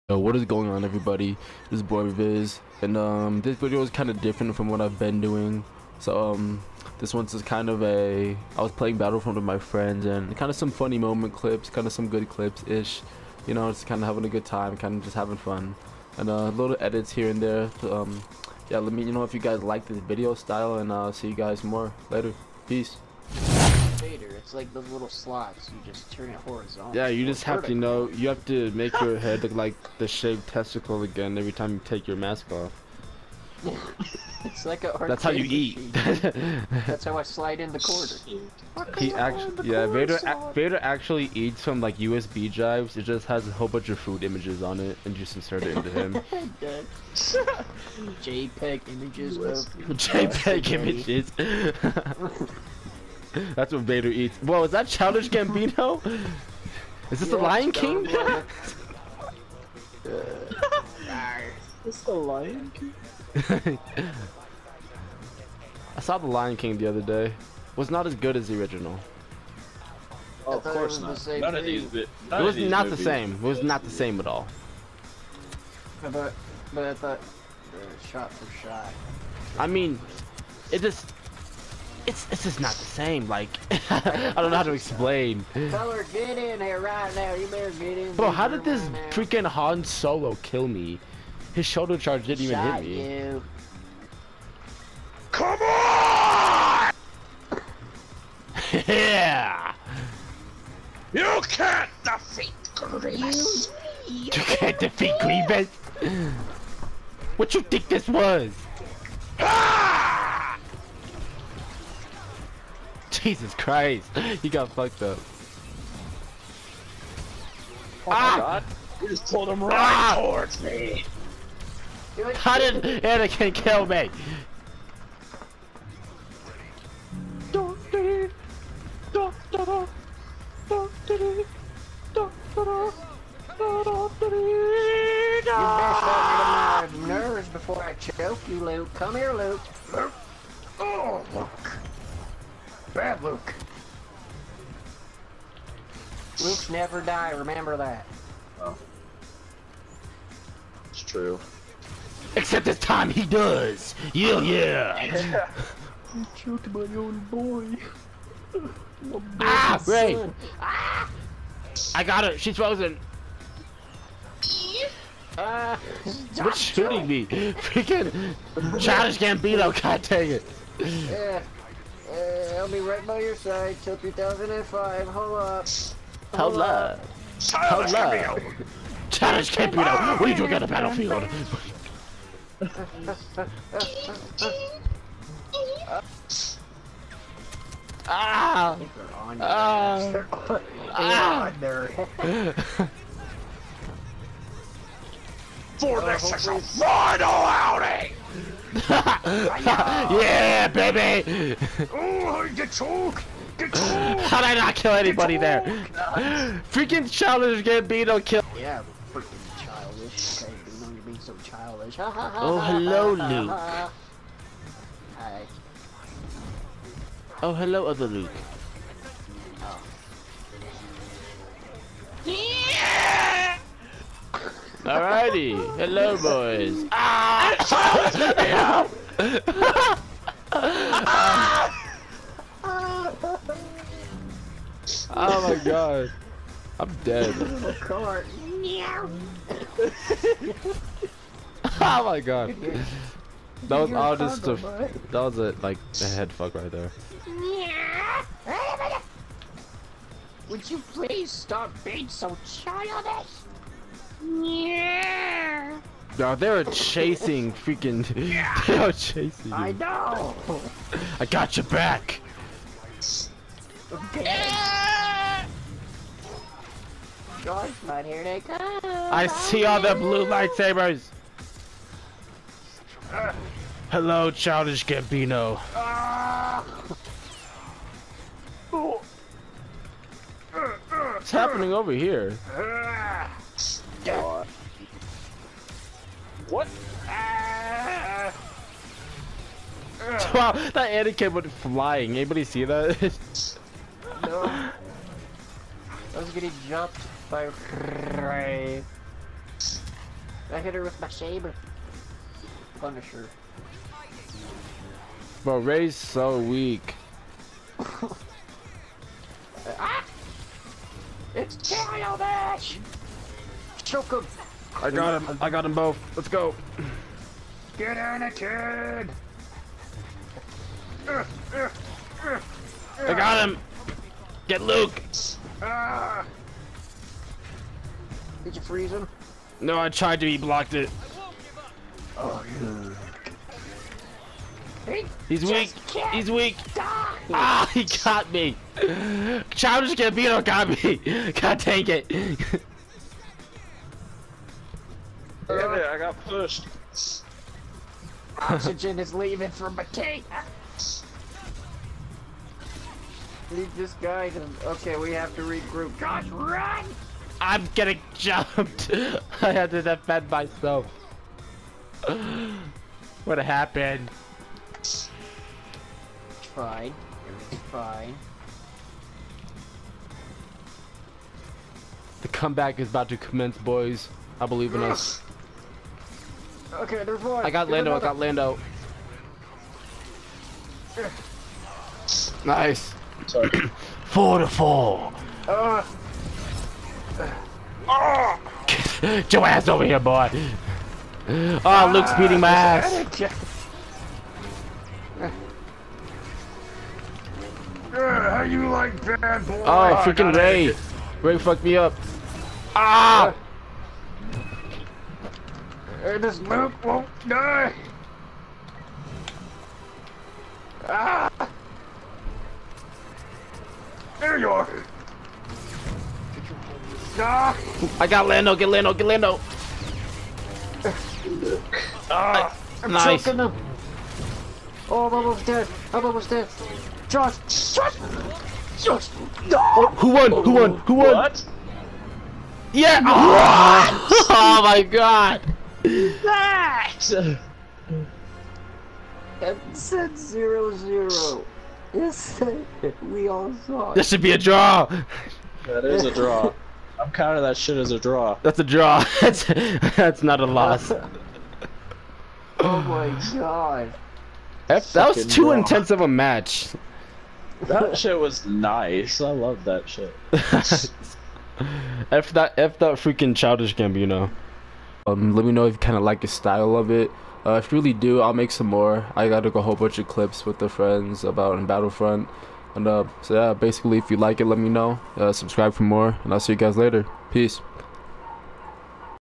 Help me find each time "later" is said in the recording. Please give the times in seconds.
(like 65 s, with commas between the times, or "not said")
22 s, 476 s.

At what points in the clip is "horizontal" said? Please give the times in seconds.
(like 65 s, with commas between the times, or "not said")
26 s.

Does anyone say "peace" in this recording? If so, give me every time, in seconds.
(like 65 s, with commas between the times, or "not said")
22 s, 477 s.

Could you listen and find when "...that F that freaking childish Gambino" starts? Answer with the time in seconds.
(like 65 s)
462 s.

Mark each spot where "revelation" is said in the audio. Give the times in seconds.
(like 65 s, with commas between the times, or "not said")
not said.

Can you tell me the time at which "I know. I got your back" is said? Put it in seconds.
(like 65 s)
259 s.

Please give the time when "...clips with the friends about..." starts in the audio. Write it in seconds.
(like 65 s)
470 s.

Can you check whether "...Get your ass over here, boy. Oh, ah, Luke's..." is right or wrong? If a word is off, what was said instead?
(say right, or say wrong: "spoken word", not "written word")
right.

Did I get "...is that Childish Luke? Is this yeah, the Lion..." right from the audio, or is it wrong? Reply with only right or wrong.
wrong.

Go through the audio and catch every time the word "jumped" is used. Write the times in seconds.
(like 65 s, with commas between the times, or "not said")
296 s, 358 s.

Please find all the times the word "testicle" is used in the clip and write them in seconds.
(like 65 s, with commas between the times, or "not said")
30 s.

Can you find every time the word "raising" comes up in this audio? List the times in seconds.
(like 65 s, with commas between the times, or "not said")
not said.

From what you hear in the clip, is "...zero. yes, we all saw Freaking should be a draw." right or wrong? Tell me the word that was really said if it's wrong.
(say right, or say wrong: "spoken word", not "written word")
wrong: "This", not "Freaking".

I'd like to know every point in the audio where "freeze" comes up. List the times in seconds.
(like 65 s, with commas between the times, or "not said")
328 s.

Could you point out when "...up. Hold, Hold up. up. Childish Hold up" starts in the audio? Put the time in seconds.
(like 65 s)
175 s.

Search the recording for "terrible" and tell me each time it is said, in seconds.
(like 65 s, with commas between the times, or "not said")
not said.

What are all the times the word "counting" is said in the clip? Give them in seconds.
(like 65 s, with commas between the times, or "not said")
447 s.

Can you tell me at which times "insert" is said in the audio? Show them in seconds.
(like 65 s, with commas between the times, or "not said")
45 s.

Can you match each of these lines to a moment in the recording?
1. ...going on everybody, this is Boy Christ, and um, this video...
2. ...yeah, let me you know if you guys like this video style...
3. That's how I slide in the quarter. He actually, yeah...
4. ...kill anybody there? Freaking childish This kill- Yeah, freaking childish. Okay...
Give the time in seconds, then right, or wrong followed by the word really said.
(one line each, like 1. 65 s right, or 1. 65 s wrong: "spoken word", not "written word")
1. 0 s wrong: "Viz", not "Christ"
2. 18 s right
3. 36 s right
4. 204 s wrong: "Gambino", not "This".